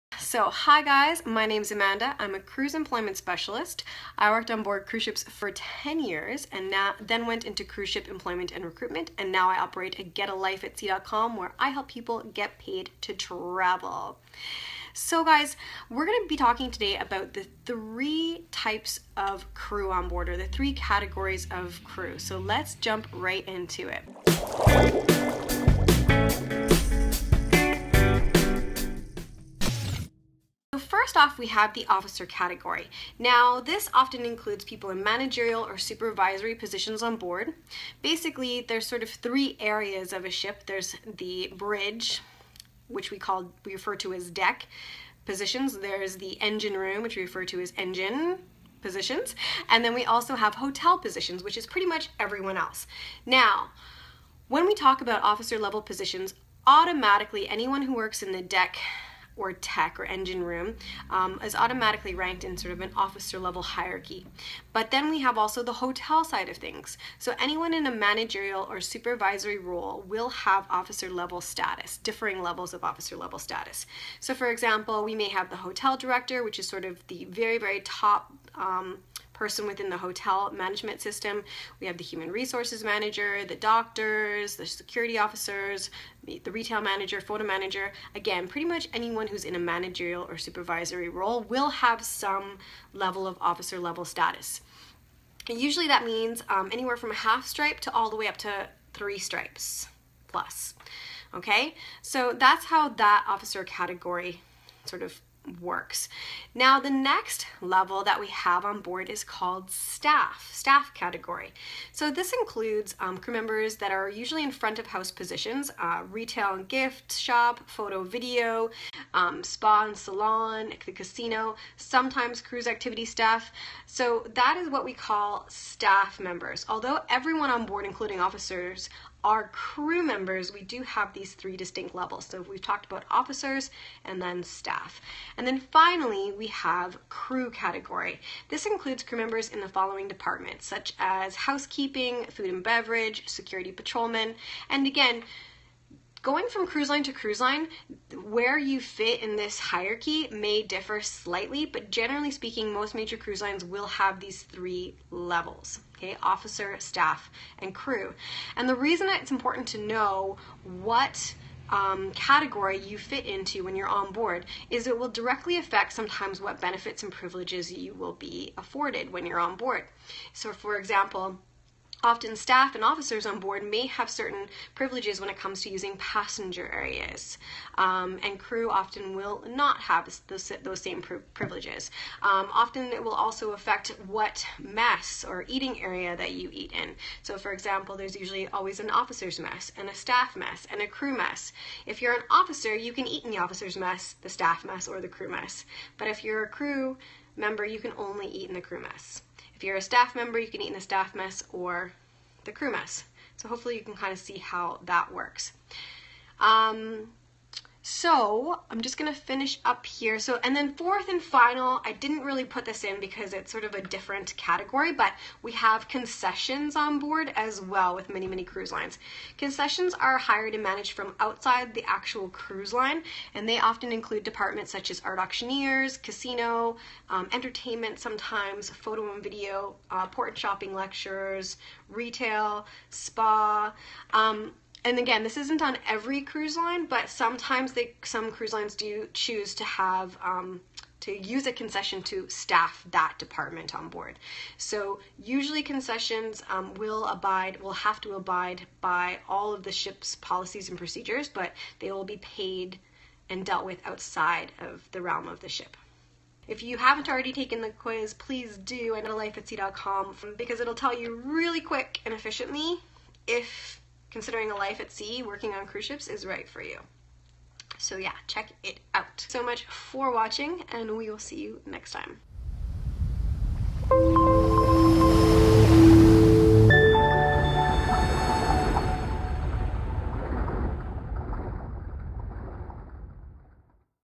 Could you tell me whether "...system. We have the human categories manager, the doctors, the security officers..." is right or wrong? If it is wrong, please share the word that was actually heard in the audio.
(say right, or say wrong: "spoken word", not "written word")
wrong: "resources", not "categories".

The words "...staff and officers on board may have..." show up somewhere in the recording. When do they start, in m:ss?
2:52.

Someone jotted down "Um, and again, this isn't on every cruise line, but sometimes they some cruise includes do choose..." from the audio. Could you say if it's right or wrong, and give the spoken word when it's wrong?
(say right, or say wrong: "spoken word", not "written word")
wrong: "lines", not "includes".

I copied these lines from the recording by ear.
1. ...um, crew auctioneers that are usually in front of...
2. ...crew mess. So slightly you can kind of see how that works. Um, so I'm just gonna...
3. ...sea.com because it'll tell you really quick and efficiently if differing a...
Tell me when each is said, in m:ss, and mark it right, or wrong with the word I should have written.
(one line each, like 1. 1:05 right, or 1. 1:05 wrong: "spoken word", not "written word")
1. 1:52 wrong: "members", not "auctioneers"
2. 3:22 wrong: "hopefully", not "slightly"
3. 4:19 wrong: "considering", not "differing".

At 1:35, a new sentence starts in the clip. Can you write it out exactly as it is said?
And usually that means um, anywhere from a half stripe to all the way up to three stripes plus.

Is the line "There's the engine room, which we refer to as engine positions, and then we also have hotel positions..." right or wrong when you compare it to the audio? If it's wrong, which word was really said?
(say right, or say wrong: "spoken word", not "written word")
right.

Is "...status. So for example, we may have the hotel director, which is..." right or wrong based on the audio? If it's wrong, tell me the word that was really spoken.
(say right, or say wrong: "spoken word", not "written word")
right.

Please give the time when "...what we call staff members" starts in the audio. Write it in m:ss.
2:04.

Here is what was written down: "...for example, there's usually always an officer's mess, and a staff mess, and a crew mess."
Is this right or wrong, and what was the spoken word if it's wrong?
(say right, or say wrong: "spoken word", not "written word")
right.